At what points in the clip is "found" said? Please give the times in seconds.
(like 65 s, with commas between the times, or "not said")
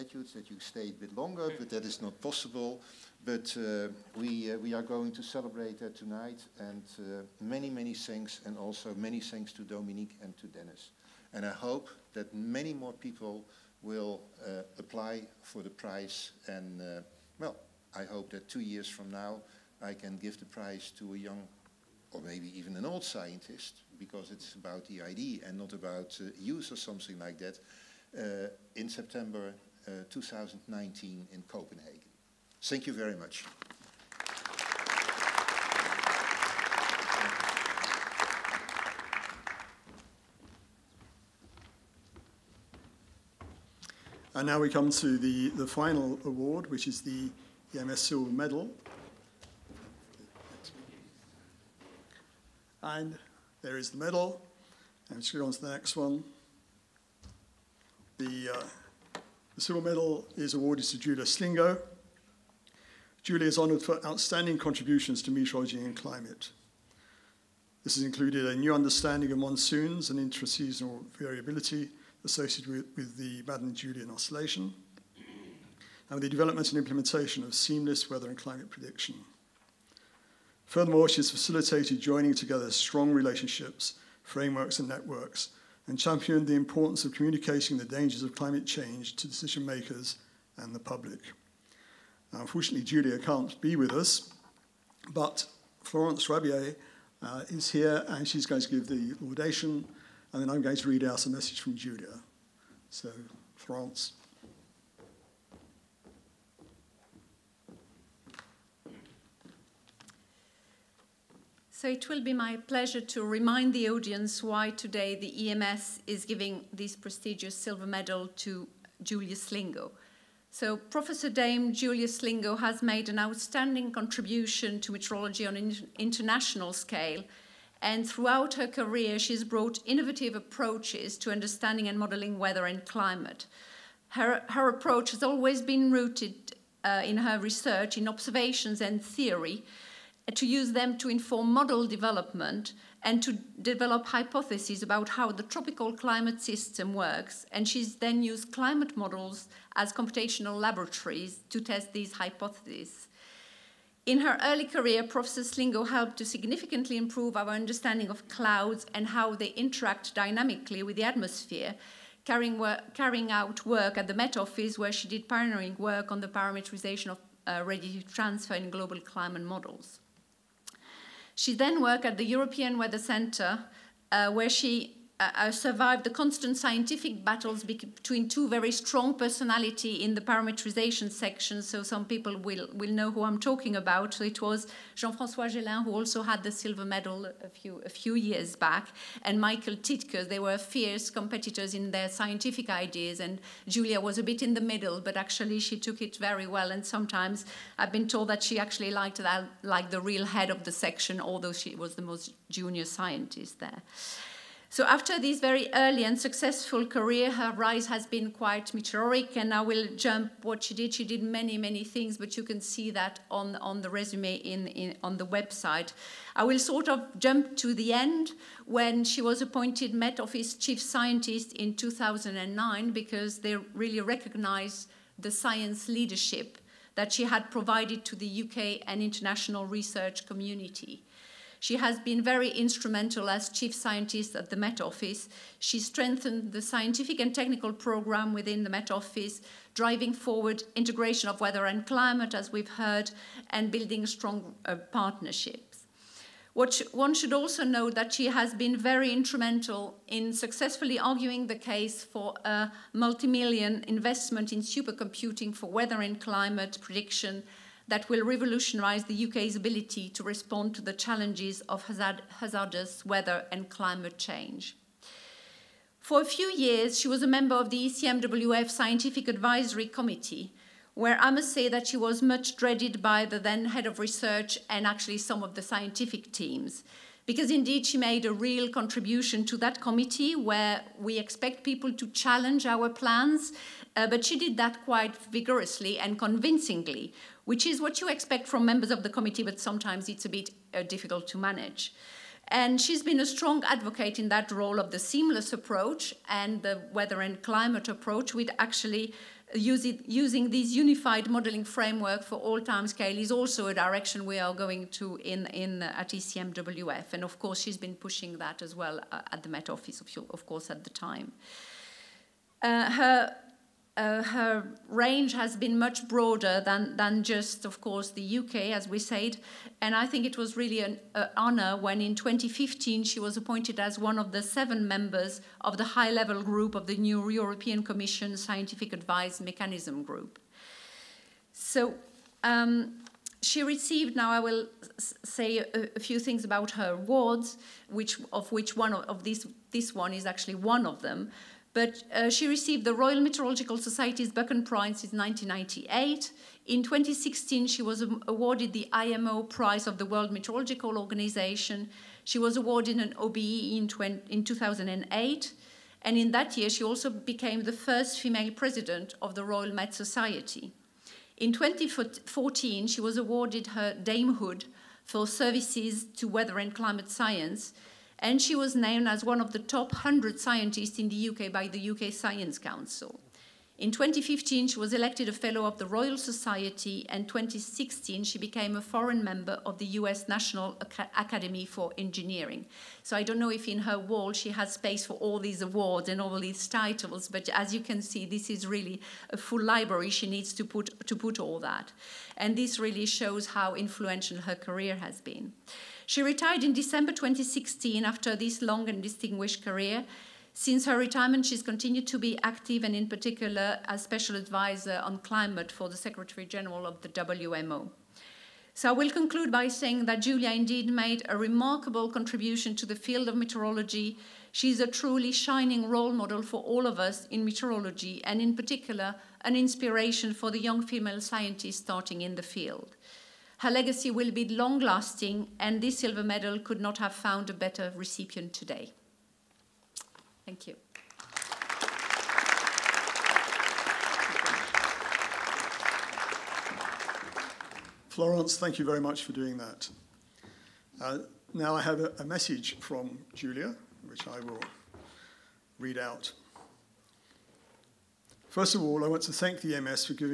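427 s.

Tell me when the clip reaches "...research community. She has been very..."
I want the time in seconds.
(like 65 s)
229 s.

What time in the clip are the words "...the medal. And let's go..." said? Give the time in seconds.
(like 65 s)
53 s.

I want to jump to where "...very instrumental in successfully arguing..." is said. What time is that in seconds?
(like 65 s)
248 s.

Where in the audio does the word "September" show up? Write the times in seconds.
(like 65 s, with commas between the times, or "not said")
28 s.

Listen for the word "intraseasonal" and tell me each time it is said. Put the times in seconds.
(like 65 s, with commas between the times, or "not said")
70 s.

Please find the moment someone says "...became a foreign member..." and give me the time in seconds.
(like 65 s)
378 s.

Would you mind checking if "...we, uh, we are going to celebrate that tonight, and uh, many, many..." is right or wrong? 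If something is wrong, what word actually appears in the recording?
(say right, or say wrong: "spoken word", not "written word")
right.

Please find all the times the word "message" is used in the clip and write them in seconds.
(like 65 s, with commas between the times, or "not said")
101 s, 442 s.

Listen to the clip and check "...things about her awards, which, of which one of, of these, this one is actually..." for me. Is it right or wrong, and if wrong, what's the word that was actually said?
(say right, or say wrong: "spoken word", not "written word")
right.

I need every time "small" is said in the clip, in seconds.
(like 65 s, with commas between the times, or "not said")
not said.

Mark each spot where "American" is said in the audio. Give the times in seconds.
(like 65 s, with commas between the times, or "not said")
not said.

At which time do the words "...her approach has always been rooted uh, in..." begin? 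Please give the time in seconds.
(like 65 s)
134 s.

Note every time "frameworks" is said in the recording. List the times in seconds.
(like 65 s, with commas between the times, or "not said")
84 s, 301 s.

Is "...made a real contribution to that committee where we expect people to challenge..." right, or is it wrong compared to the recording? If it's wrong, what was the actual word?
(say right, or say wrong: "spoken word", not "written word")
right.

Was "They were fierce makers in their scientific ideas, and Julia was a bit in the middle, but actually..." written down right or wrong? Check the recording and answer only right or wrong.
wrong.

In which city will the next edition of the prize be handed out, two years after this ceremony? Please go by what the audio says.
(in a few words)
Copenhagen.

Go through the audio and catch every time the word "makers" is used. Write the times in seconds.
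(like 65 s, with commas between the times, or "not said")
89 s.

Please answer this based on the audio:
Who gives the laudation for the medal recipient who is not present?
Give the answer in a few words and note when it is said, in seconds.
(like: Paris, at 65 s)
Florence Rabier, at 95 s.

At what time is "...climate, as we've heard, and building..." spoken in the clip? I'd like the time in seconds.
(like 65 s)
241 s.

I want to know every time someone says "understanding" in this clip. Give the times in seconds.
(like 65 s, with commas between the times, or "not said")
68 s, 131 s, 157 s.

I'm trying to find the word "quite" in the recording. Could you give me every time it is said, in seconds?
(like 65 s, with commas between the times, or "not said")
208 s, 284 s.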